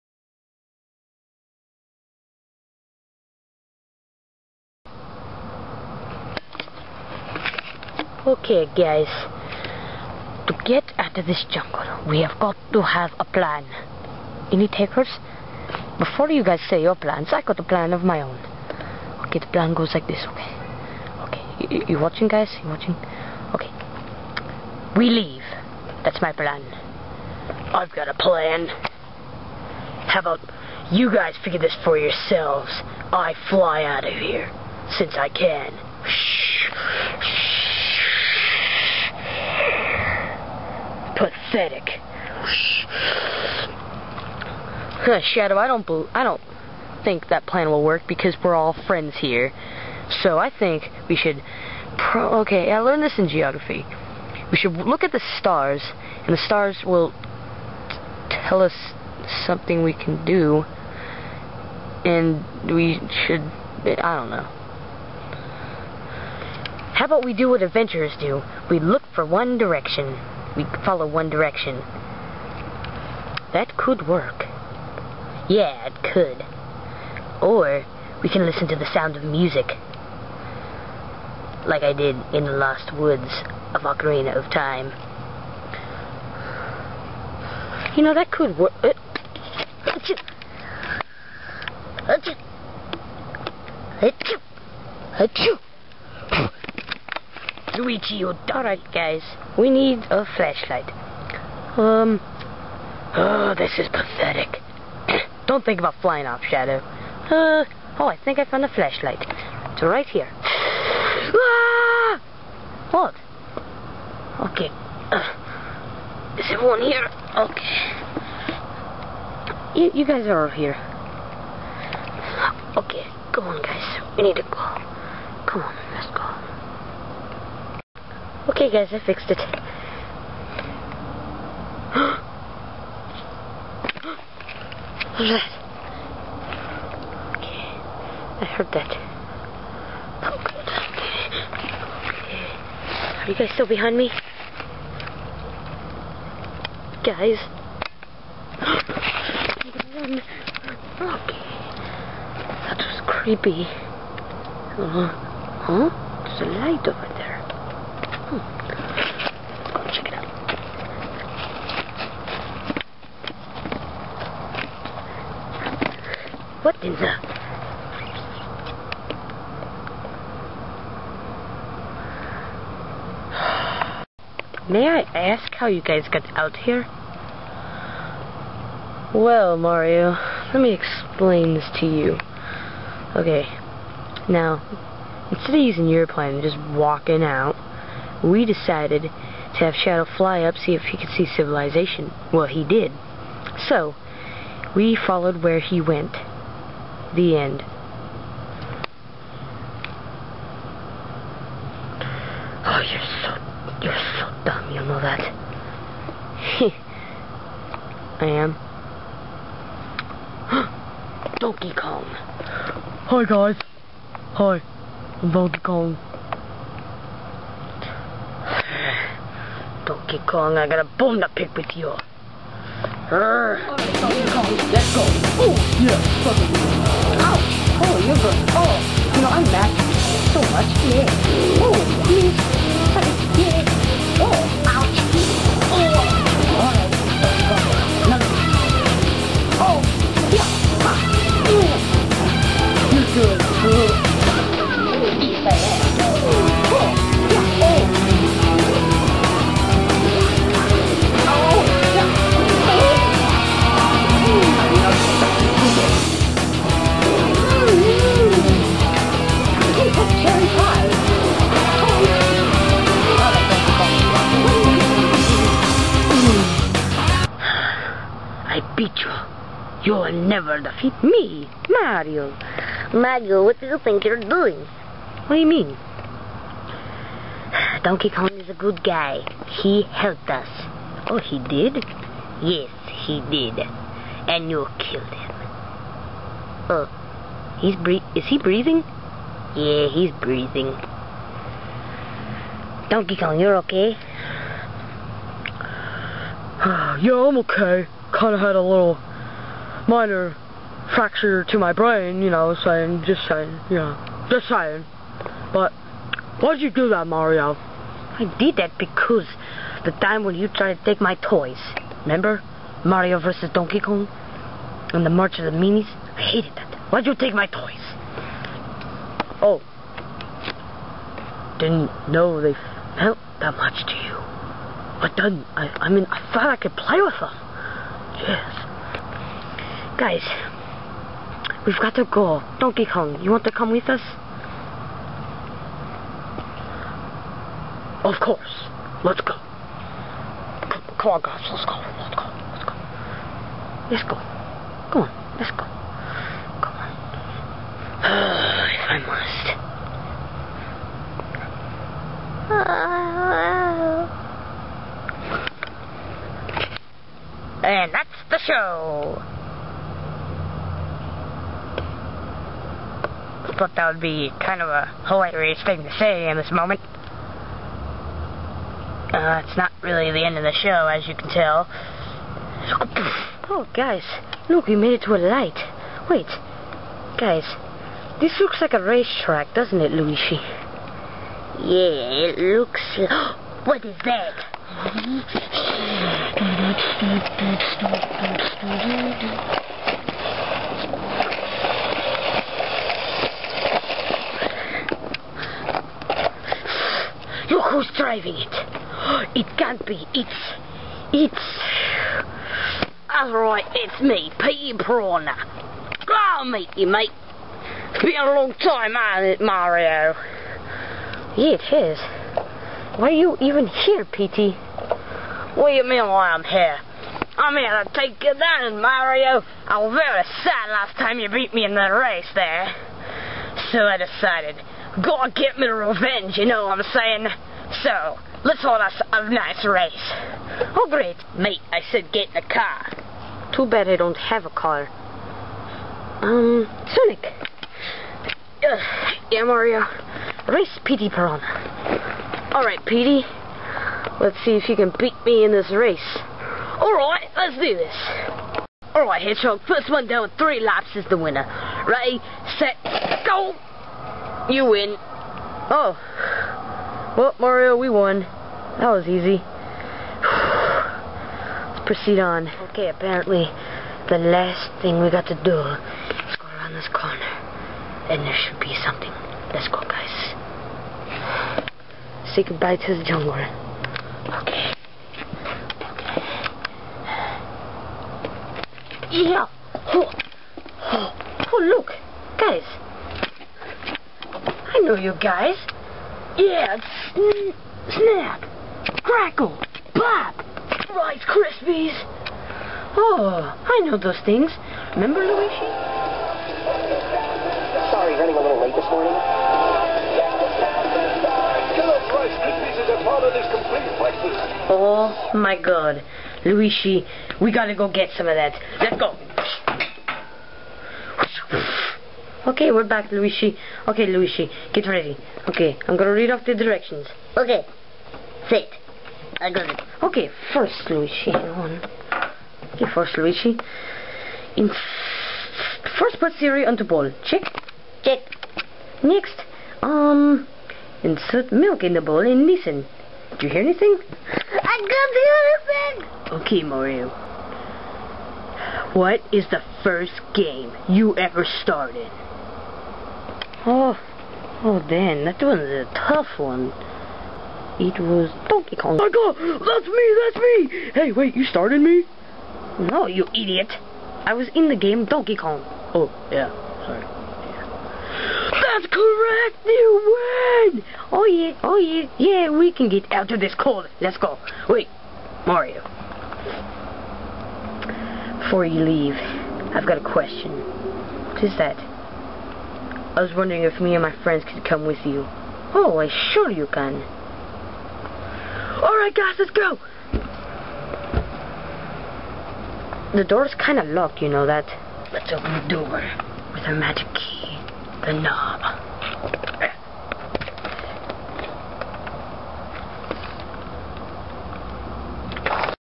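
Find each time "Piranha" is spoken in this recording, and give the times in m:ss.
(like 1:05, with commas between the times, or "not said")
6:44, 7:21.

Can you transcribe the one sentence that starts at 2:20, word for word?
Oh, Are you guys still behind me?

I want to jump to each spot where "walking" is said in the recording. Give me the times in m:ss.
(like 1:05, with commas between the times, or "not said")
3:06.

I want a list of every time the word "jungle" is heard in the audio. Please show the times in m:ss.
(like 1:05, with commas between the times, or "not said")
0:11, 7:53.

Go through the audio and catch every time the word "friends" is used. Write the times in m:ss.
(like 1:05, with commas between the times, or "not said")
0:48, 9:34.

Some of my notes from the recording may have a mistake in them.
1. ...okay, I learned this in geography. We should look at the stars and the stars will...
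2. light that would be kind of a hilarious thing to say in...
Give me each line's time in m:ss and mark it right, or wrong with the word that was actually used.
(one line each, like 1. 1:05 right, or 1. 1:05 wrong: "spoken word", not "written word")
1. 0:52 right
2. 6:03 wrong: "thought", not "light".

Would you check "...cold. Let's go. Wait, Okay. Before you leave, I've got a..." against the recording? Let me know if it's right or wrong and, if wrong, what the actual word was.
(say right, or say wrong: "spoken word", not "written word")
wrong: "Mario", not "Okay".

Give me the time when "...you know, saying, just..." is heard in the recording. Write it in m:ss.
5:02.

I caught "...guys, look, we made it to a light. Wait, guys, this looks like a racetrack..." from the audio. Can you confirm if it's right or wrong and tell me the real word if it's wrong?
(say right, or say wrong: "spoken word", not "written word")
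right.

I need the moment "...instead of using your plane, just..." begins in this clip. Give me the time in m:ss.
3:05.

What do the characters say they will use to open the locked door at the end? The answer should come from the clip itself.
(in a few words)
Magic key.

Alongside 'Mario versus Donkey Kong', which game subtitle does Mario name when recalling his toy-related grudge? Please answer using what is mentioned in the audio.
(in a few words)
March of the Minis.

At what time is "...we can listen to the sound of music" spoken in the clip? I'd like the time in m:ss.
1:18.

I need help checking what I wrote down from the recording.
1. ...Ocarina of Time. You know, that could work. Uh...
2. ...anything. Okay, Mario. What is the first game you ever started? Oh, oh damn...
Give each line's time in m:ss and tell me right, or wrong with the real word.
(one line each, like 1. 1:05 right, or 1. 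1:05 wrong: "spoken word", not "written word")
1. 1:23 right
2. 8:56 right.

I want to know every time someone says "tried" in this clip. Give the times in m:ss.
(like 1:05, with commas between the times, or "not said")
5:10.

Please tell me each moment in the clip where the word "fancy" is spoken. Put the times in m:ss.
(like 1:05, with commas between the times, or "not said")
not said.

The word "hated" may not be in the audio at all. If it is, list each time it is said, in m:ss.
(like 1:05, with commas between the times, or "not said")
5:16.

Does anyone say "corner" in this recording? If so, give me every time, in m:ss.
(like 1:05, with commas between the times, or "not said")
7:46.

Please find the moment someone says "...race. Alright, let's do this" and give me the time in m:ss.
7:25.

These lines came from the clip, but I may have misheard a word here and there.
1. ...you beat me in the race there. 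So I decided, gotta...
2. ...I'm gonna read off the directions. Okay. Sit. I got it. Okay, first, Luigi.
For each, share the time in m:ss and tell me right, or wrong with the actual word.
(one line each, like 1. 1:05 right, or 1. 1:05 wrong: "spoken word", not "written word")
1. 7:01 right
2. 8:35 right.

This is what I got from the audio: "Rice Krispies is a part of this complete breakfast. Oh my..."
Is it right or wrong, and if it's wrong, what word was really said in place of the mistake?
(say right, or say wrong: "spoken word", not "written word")
right.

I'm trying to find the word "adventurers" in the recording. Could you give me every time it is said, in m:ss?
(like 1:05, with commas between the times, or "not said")
1:07.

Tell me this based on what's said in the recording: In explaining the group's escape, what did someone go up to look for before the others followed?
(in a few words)
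Civilization.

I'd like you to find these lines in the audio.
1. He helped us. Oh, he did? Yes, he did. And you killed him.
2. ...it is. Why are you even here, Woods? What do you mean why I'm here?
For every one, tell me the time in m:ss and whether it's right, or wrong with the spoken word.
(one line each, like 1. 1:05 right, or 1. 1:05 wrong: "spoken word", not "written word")
1. 4:39 right
2. 6:51 wrong: "Petey", not "Woods".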